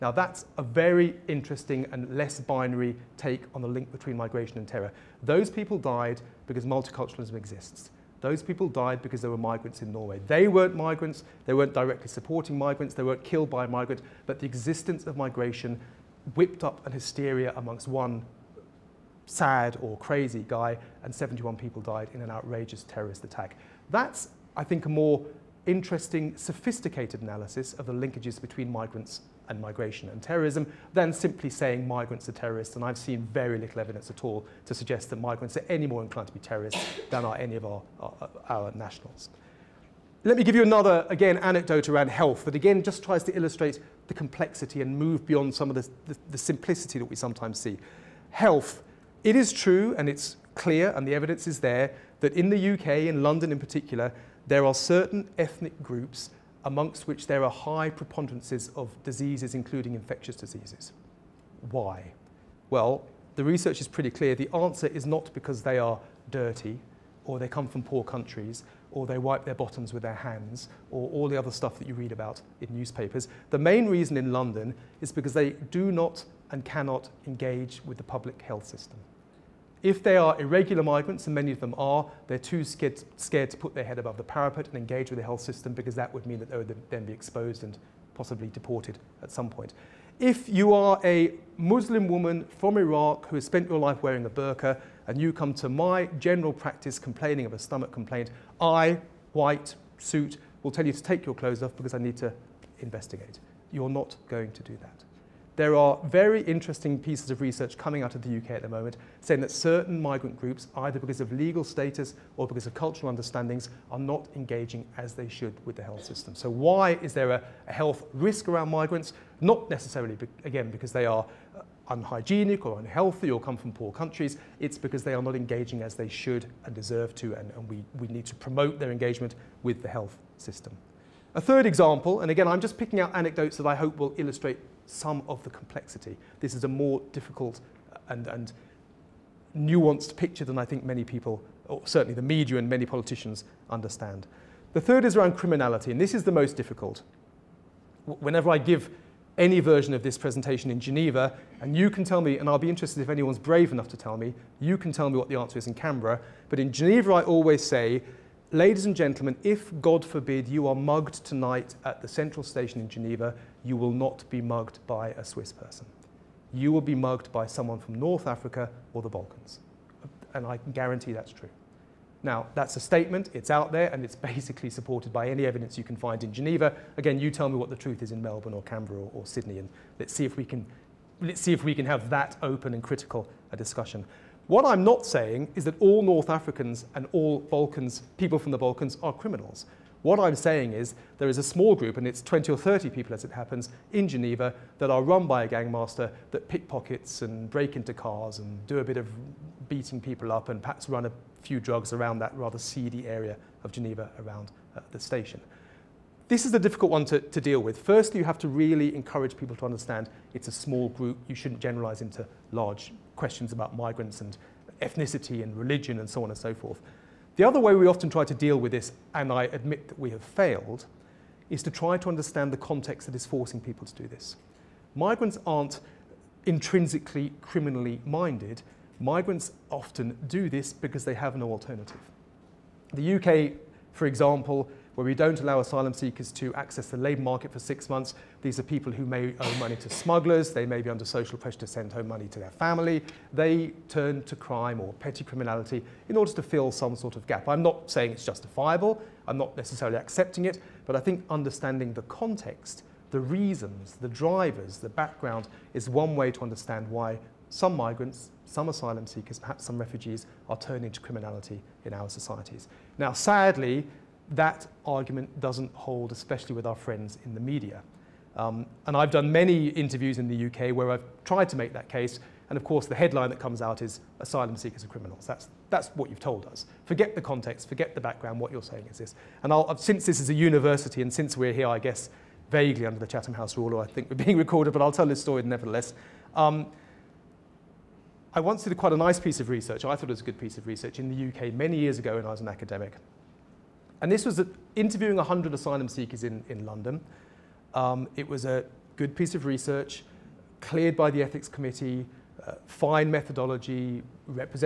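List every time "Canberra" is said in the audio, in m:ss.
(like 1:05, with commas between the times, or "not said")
2:35, 2:58.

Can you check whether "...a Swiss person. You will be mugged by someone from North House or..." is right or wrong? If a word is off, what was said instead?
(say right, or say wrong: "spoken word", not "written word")
wrong: "Africa", not "House".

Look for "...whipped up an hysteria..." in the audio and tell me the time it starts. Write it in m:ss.
0:16.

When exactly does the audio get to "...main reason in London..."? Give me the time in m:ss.
1:13.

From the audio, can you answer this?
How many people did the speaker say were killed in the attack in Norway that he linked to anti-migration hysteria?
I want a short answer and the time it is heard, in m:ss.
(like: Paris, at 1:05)
71, at 0:21.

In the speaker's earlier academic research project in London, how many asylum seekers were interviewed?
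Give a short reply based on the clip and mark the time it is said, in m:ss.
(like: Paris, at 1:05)
100, at 4:55.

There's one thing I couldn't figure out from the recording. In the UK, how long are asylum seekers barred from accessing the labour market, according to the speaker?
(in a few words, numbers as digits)
six months.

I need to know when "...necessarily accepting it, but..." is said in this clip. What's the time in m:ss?
4:09.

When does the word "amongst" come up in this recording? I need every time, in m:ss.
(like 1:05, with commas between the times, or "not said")
0:17, 0:56.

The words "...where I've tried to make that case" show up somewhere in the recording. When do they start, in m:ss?
4:30.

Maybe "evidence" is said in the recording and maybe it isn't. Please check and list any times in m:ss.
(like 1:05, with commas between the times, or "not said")
0:33, 0:51, 2:55.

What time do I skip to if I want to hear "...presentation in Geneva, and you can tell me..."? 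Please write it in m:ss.
2:30.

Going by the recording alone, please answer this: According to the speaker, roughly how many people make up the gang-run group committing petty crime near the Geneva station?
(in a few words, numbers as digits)
20 or 30.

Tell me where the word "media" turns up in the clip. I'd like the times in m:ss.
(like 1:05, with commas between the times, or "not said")
2:22, 4:27.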